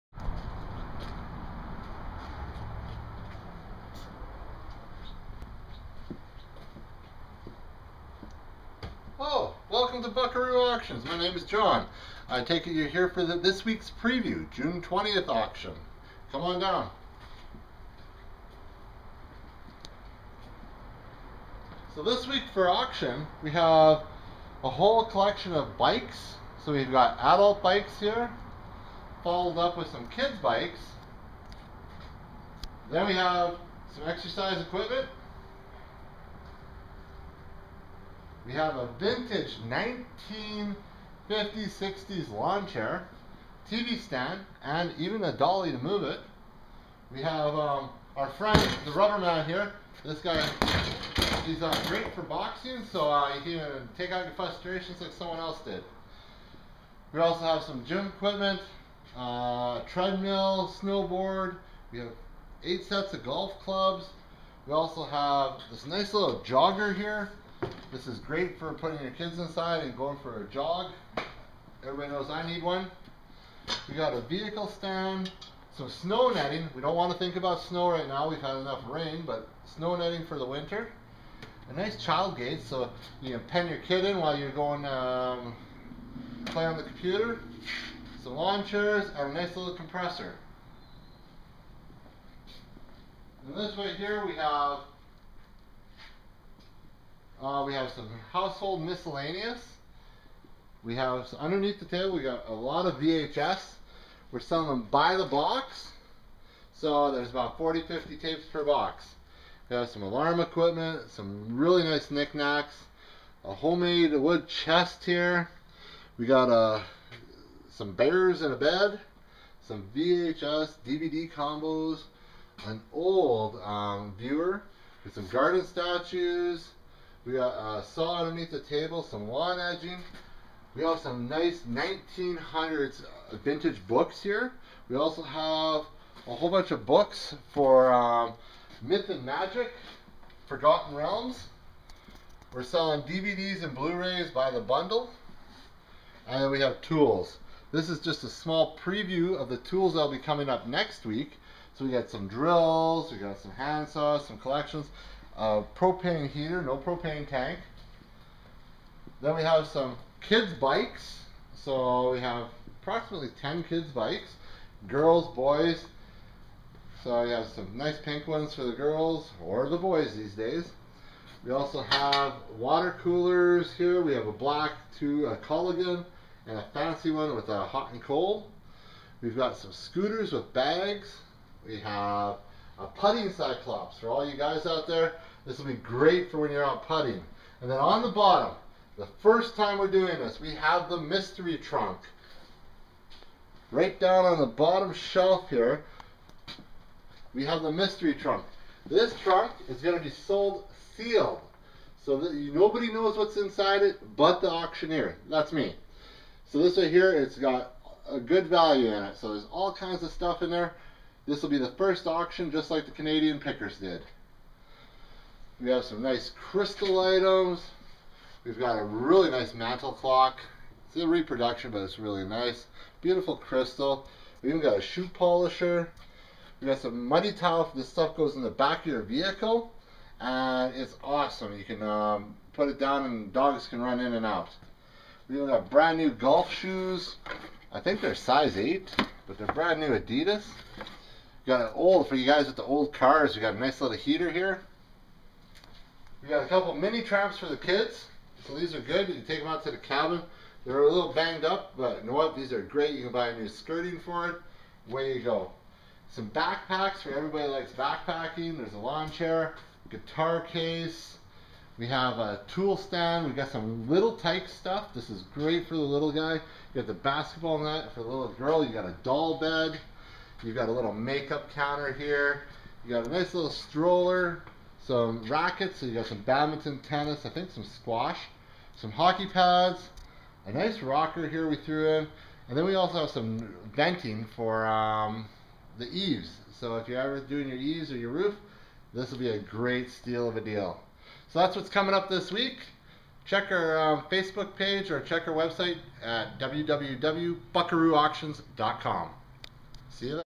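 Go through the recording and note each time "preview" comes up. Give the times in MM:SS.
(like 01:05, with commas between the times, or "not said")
00:14, 02:28.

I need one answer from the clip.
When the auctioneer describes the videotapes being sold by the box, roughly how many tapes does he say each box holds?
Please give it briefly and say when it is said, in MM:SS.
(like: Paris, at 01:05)
40 to 50, at 01:47.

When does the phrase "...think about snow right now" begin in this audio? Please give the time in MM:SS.
01:17.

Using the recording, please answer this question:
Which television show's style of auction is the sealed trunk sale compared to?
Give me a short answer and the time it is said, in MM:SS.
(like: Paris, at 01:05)
Canadian Pickers, at 03:32.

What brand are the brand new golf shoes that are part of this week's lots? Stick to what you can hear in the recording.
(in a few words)
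Adidas.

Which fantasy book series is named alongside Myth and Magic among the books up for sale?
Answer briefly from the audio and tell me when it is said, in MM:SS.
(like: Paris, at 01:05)
Forgotten Realms, at 02:20.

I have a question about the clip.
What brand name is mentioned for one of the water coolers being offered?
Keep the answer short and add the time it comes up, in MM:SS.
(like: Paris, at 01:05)
Culligan, at 02:55.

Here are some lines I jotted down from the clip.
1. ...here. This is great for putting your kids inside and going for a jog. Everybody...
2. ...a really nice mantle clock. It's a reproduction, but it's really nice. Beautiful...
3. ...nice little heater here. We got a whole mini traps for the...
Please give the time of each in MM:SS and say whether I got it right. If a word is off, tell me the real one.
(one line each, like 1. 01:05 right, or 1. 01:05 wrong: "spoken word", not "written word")
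1. 01:06 right
2. 03:38 right
3. 04:03 wrong: "couple", not "whole".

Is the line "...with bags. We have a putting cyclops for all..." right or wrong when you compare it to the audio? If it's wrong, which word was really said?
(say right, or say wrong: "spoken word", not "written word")
right.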